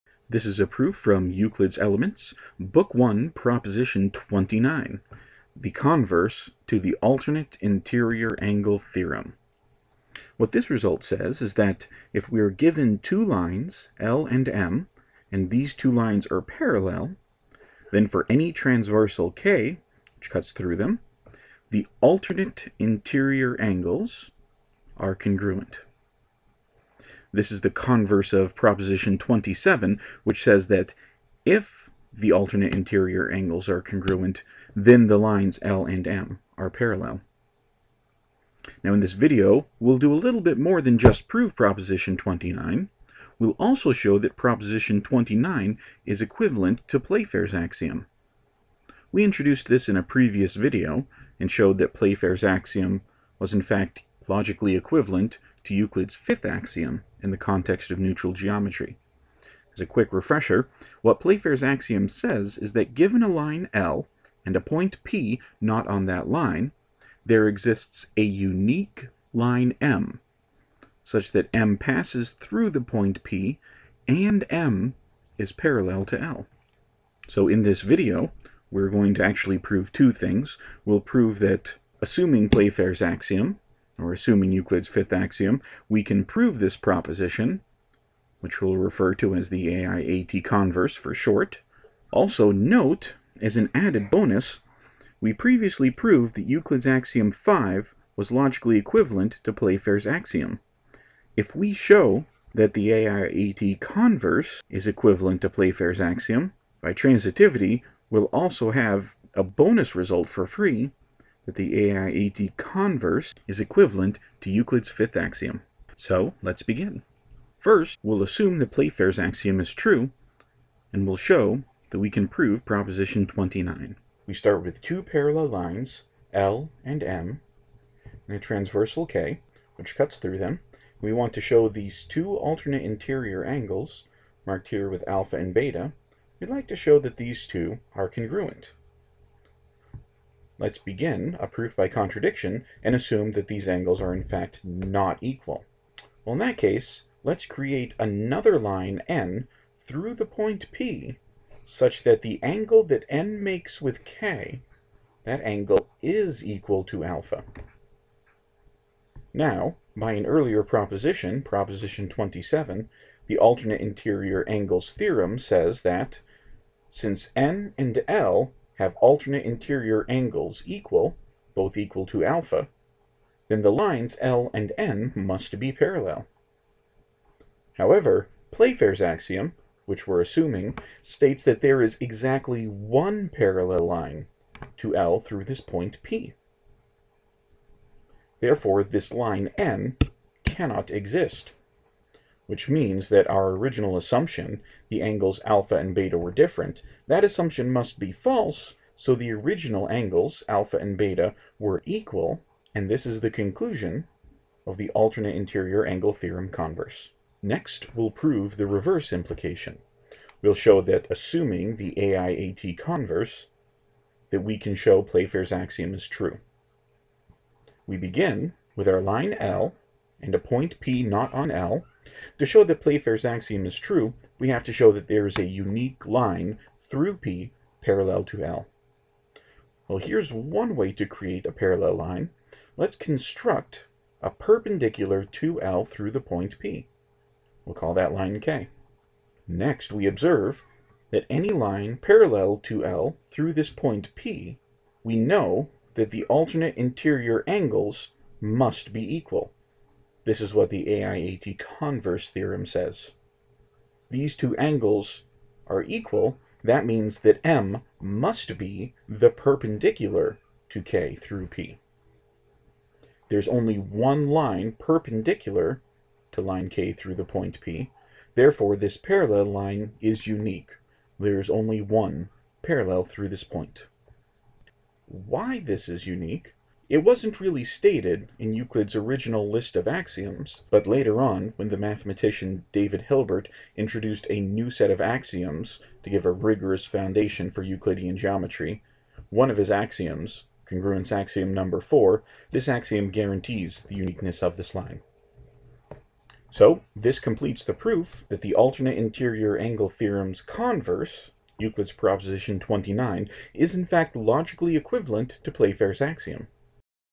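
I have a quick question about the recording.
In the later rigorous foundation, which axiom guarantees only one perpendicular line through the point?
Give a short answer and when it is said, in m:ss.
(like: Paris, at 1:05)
Congruence axiom 4, at 4:50.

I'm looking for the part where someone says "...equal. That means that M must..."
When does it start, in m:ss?
4:15.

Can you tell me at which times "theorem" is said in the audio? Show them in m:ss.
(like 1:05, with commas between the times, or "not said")
0:08, 2:44, 3:26, 4:12, 4:59.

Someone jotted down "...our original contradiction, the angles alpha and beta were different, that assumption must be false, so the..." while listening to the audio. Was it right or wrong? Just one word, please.
wrong.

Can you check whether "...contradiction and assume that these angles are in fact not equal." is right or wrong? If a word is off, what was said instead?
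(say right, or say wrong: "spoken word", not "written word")
right.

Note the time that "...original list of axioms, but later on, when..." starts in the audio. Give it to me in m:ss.
4:38.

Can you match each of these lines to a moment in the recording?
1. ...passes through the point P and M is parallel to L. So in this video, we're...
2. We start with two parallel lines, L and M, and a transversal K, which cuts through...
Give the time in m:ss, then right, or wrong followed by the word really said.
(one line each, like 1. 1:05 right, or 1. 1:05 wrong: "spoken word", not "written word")
1. 1:11 right
2. 2:04 right.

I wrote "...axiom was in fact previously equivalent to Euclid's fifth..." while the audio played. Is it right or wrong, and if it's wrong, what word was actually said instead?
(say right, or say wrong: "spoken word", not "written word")
wrong: "logically", not "previously".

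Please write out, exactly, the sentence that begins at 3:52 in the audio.
Let's construct a perpendicular to L through the point P.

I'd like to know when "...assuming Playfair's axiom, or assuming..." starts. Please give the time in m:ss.
1:22.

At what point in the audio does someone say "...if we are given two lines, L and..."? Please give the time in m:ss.
0:12.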